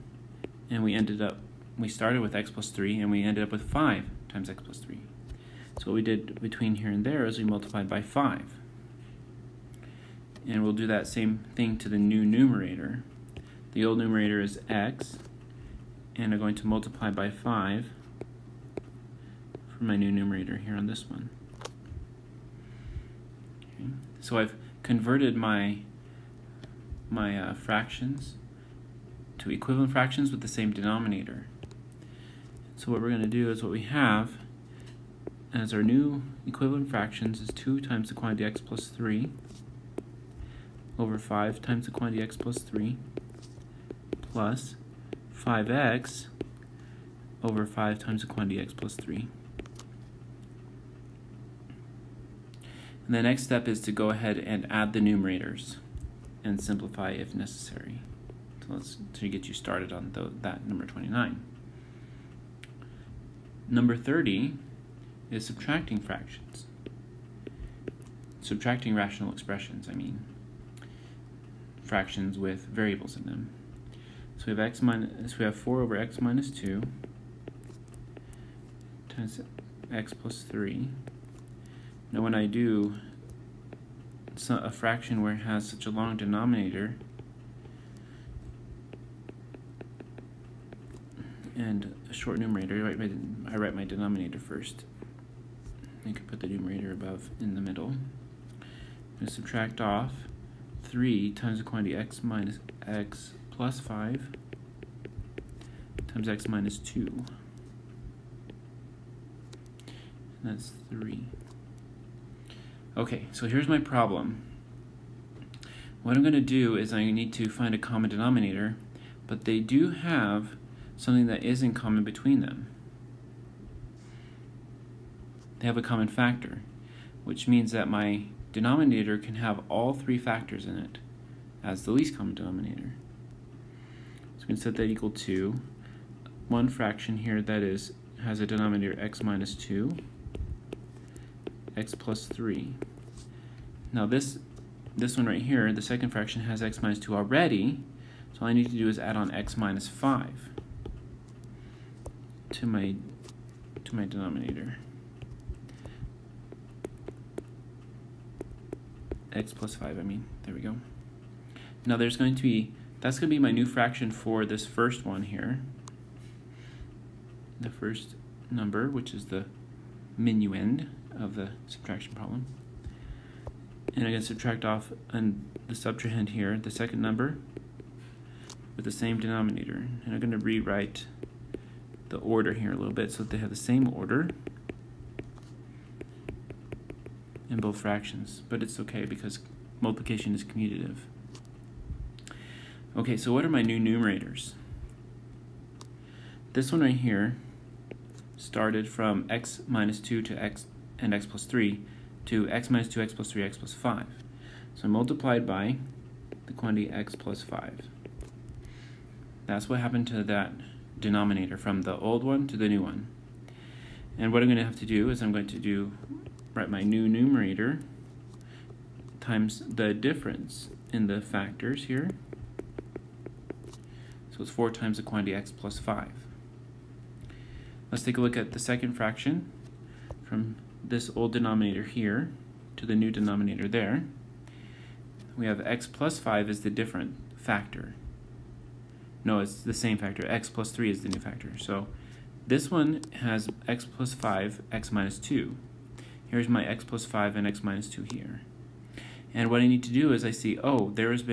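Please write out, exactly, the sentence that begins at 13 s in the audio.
The old numerator is x, and I'm going to multiply by 5 for my new numerator here on this one.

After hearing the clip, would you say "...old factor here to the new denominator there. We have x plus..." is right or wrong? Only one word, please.
wrong.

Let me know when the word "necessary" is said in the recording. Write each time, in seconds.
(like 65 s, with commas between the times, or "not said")
57 s.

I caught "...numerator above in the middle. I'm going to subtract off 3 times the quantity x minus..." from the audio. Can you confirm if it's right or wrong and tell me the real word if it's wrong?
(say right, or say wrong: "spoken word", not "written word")
right.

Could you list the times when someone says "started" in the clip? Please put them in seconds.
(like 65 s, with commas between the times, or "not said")
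1 s, 59 s, 198 s.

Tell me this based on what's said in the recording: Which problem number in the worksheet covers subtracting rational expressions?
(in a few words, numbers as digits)
30.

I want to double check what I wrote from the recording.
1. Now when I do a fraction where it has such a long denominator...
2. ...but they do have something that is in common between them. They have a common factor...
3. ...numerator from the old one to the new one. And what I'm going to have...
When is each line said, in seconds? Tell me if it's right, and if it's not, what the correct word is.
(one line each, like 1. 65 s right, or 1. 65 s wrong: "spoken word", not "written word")
1. 82 s right
2. 119 s right
3. 210 s wrong: "denominator", not "numerator".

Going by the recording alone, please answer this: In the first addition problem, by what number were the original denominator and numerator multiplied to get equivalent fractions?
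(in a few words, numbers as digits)
5.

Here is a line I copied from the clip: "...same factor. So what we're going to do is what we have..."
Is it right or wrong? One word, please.
wrong.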